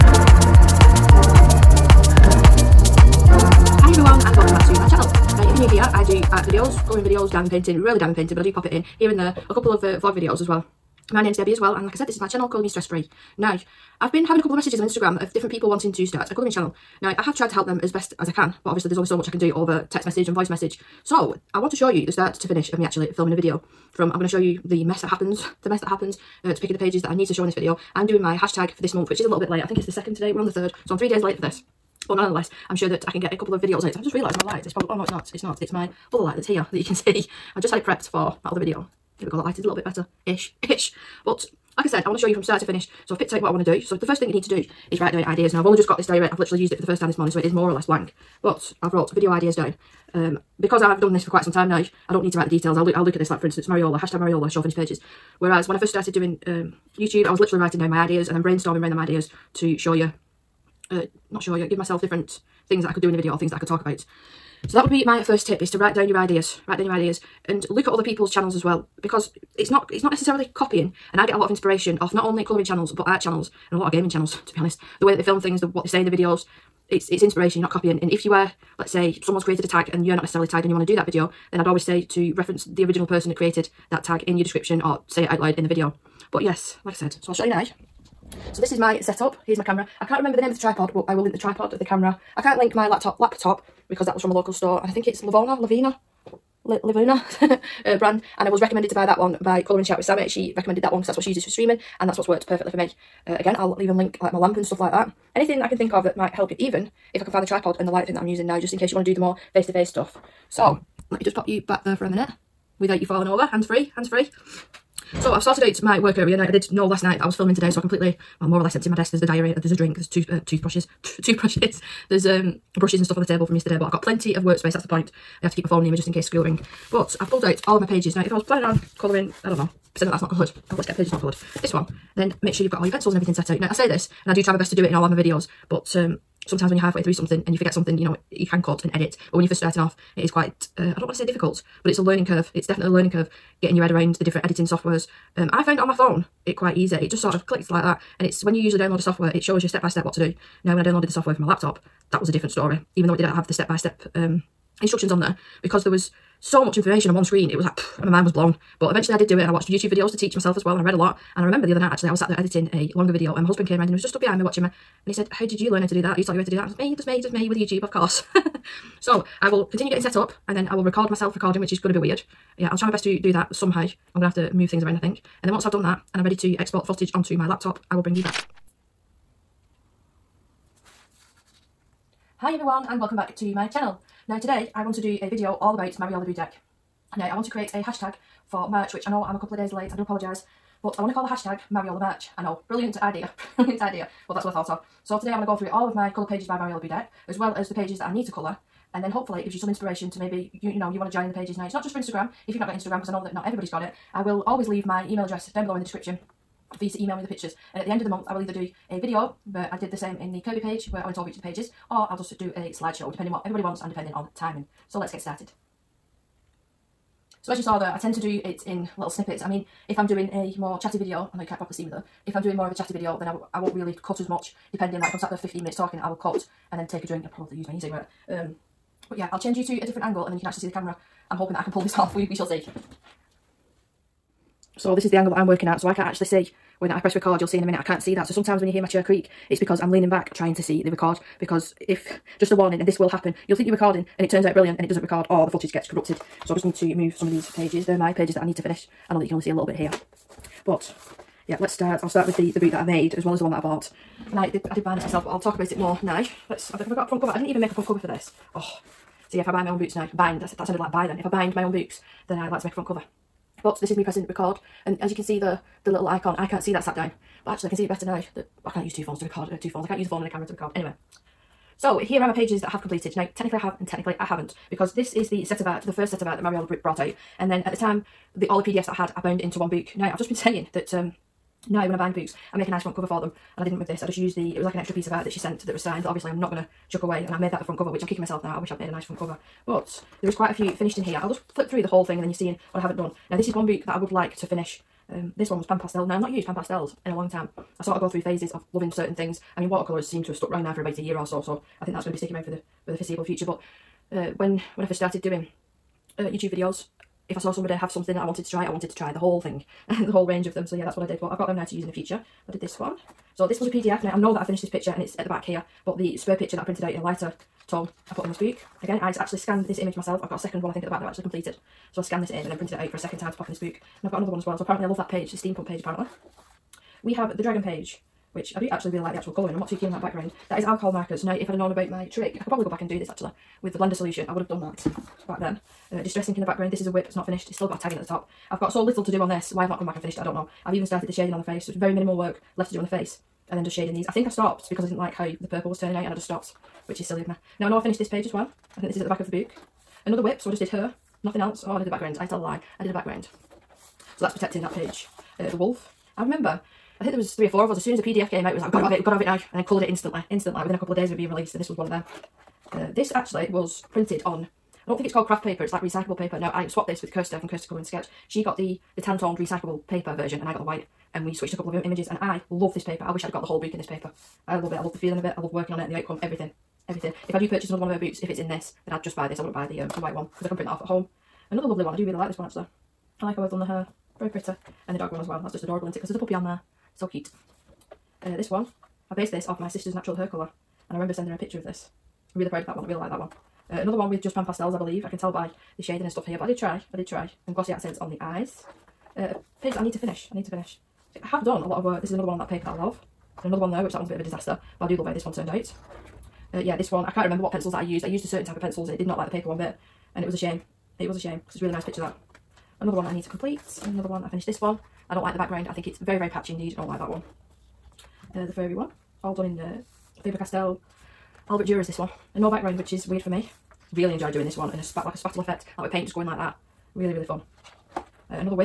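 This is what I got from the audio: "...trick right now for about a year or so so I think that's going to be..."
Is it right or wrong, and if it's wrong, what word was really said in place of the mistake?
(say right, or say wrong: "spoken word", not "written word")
wrong: "stuck", not "trick".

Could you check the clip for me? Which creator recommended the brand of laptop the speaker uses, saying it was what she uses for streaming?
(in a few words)
Colouring Chat with Sammy.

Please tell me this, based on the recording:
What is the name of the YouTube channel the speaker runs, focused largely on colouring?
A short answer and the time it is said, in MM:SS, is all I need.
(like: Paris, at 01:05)
Colour Me Stress Free, at 00:12.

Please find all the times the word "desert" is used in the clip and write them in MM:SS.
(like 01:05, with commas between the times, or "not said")
not said.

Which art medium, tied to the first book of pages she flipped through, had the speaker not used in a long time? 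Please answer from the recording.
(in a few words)
Pan Pastel.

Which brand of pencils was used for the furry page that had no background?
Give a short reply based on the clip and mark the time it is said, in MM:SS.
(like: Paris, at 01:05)
Faber-Castell Albert Durer, at 07:00.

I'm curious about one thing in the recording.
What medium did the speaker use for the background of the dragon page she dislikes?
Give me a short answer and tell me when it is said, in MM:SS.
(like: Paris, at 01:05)
distress ink, at 05:36.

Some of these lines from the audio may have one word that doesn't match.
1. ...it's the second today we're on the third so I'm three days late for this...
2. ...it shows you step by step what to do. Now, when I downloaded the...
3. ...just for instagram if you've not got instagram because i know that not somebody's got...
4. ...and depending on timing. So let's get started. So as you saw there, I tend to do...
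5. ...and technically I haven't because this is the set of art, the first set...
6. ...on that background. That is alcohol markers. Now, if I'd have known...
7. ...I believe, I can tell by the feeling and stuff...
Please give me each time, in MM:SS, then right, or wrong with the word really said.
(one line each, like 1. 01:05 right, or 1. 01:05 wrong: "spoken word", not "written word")
1. 00:29 right
2. 02:29 right
3. 03:21 wrong: "everybody", not "somebody"
4. 03:33 right
5. 04:33 right
6. 05:29 right
7. 06:34 wrong: "shading", not "feeling".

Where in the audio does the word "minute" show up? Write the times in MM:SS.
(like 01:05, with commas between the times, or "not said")
01:52, 03:45, 03:57.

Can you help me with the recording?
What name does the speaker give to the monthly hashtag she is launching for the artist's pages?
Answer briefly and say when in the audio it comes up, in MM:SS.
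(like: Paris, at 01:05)
Mariola March, at 03:11.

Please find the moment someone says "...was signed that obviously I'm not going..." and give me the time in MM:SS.
04:45.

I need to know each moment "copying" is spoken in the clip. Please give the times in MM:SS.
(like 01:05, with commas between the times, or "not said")
01:10, 01:17.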